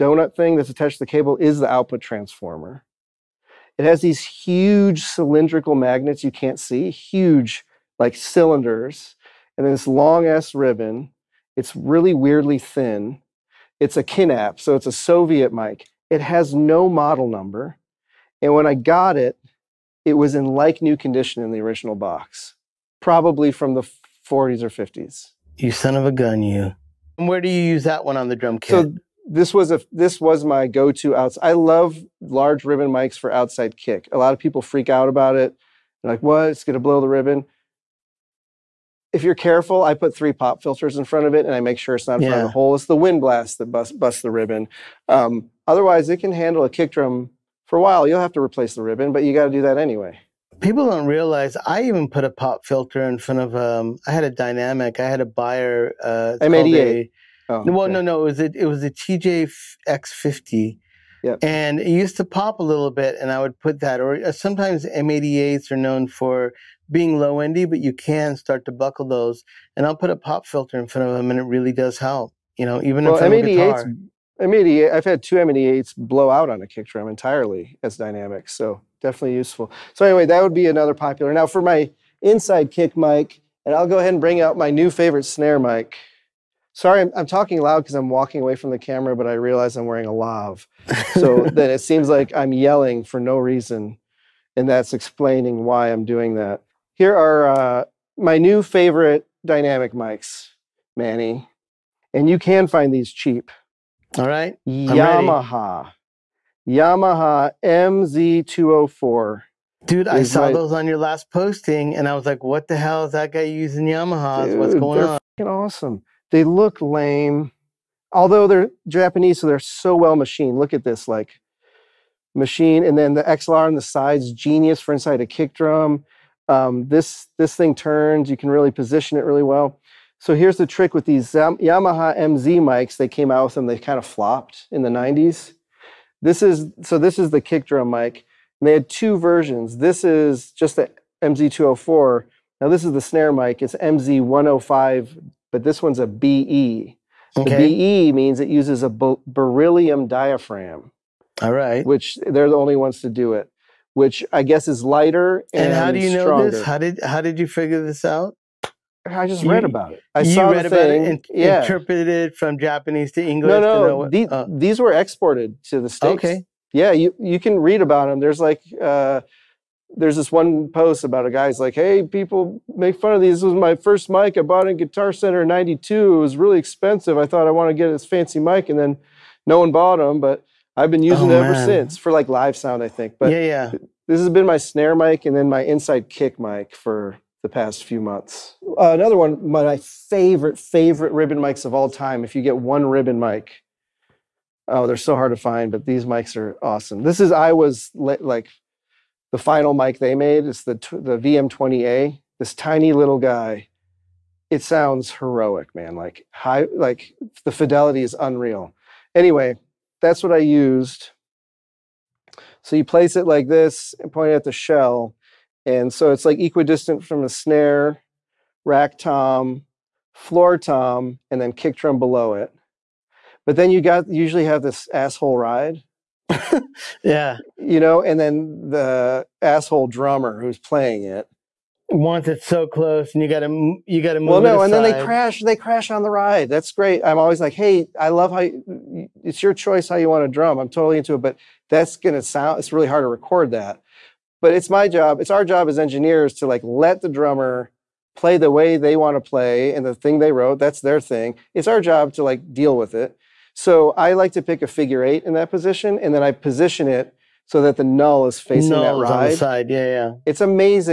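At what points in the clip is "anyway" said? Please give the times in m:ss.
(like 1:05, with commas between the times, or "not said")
0:49, 1:20, 3:29.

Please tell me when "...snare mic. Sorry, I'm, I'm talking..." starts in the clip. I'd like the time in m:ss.
1:25.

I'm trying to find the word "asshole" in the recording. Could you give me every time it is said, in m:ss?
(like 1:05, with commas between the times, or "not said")
3:44, 3:49.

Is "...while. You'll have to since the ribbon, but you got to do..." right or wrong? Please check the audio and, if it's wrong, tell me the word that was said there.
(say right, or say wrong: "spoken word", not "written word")
wrong: "replace", not "since".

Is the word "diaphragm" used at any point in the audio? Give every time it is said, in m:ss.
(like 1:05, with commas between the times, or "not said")
2:30.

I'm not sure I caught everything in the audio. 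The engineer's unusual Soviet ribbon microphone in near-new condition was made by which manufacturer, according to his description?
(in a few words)
Kinap.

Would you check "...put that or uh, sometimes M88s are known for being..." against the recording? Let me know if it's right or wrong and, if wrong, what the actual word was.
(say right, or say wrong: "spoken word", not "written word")
right.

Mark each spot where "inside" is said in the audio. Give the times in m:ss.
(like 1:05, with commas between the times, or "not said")
1:22, 2:04, 3:05.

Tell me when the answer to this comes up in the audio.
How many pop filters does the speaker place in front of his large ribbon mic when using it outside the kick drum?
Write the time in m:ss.
0:40.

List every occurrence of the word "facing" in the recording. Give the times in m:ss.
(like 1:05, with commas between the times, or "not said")
4:18.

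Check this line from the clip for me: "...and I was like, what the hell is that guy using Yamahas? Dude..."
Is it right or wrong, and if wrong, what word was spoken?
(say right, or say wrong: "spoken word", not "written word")
right.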